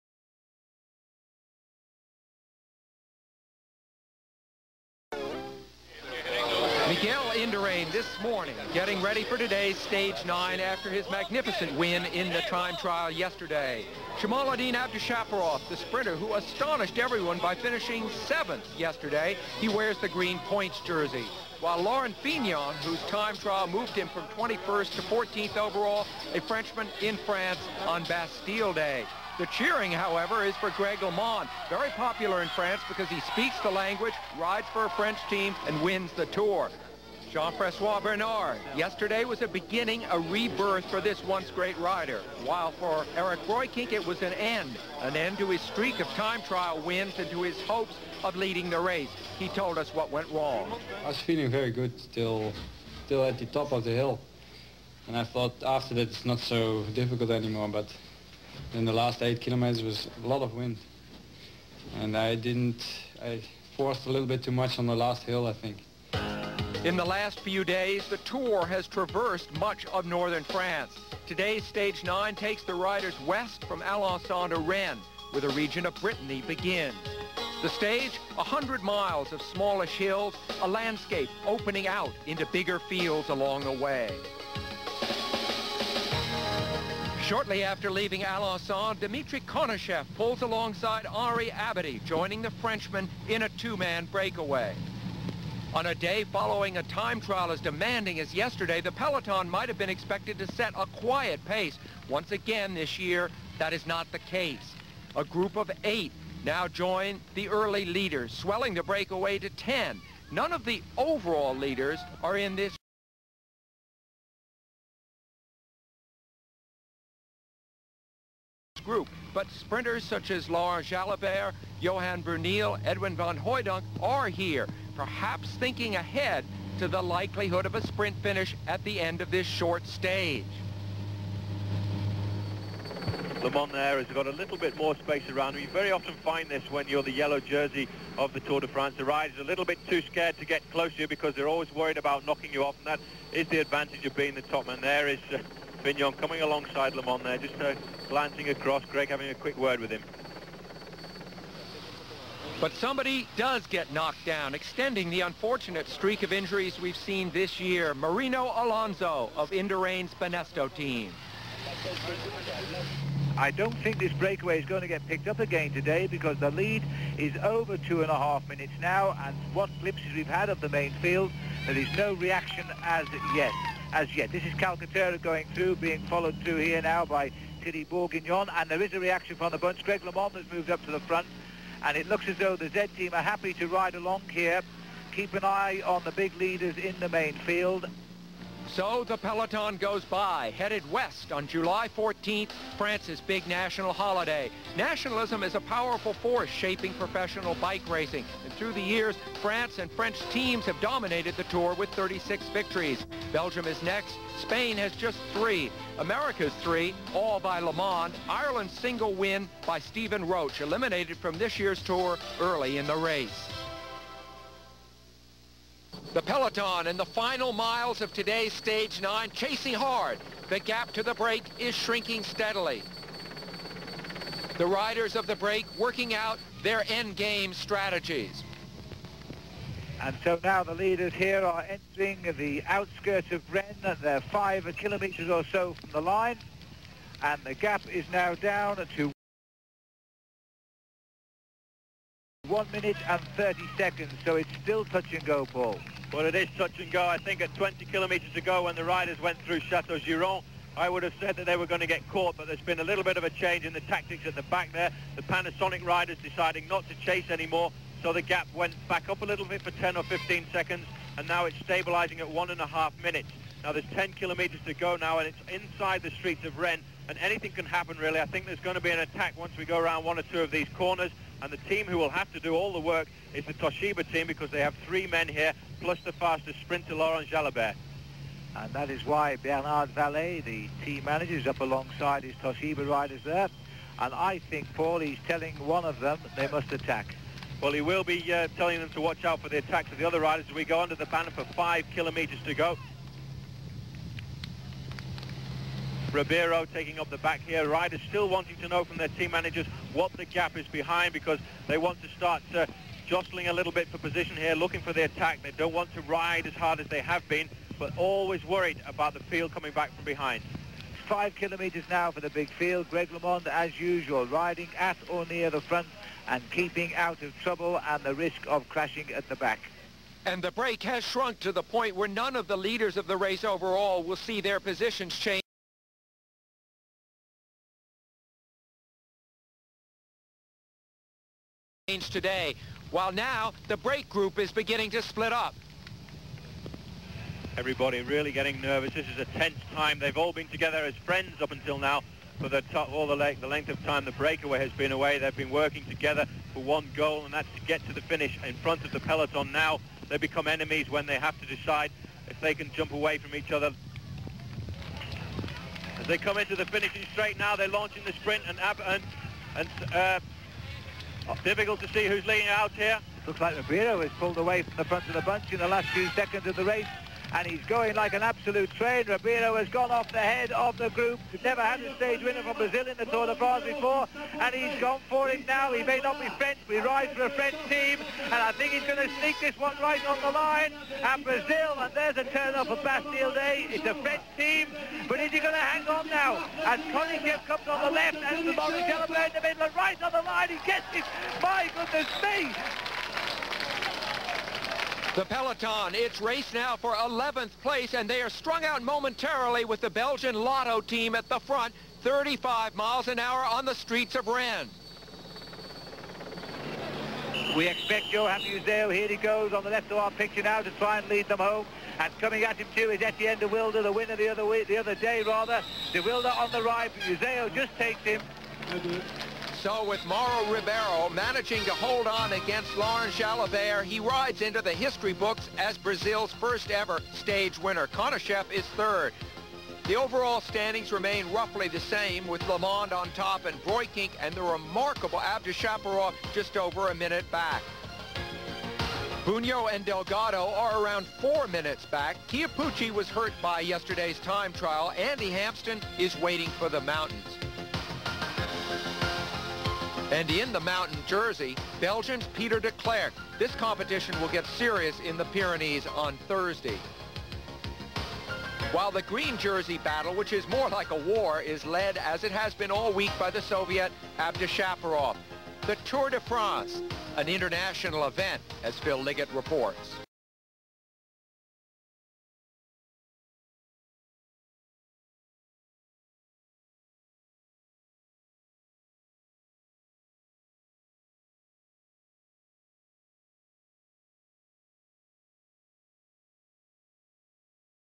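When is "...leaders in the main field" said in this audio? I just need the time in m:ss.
3:06.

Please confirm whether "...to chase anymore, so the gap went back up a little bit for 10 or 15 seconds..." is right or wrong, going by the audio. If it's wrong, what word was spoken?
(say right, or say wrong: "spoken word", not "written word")
right.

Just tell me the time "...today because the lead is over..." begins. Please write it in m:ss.
2:45.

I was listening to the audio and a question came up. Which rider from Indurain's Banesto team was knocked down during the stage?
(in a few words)
Marino Alonso.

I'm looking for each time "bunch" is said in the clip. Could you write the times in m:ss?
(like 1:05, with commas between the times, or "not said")
2:59, 6:05.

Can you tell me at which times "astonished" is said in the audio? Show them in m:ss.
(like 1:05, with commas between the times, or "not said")
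0:16.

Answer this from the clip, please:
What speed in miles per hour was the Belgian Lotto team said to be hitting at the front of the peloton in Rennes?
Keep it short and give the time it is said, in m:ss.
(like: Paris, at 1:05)
35, at 6:42.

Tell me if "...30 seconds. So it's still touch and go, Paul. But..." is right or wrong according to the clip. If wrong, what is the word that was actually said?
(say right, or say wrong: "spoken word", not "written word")
right.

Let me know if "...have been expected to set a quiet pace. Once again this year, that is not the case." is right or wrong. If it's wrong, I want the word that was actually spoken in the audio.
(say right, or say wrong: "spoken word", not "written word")
right.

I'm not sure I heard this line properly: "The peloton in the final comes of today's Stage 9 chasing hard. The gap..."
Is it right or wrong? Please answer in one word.
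wrong.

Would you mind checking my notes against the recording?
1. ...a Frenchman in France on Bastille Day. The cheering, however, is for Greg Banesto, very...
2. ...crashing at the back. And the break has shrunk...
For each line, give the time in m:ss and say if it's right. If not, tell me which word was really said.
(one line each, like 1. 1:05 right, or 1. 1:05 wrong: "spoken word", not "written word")
1. 0:26 wrong: "LeMond", not "Banesto"
2. 5:18 right.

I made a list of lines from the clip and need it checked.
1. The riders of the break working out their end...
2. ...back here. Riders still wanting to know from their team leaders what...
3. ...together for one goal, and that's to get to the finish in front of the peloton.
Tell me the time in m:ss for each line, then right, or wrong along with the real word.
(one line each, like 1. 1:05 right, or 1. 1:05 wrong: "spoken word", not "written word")
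1. 3:44 right
2. 4:57 wrong: "managers", not "leaders"
3. 5:45 right.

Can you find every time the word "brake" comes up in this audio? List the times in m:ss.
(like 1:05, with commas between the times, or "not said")
5:33.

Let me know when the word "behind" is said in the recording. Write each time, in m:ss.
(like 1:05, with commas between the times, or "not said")
5:00, 5:10.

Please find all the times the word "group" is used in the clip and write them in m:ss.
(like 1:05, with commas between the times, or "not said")
1:45, 1:58, 5:34, 6:10.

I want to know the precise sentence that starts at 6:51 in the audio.
And coming at him too is Etienne de Wilde, the winner the other week, the other day rather.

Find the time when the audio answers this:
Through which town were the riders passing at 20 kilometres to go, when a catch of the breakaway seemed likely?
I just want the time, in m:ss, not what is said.
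4:09.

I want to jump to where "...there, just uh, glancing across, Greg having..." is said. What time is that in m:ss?
2:27.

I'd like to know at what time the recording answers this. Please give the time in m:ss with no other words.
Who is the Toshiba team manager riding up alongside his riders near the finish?
4:39.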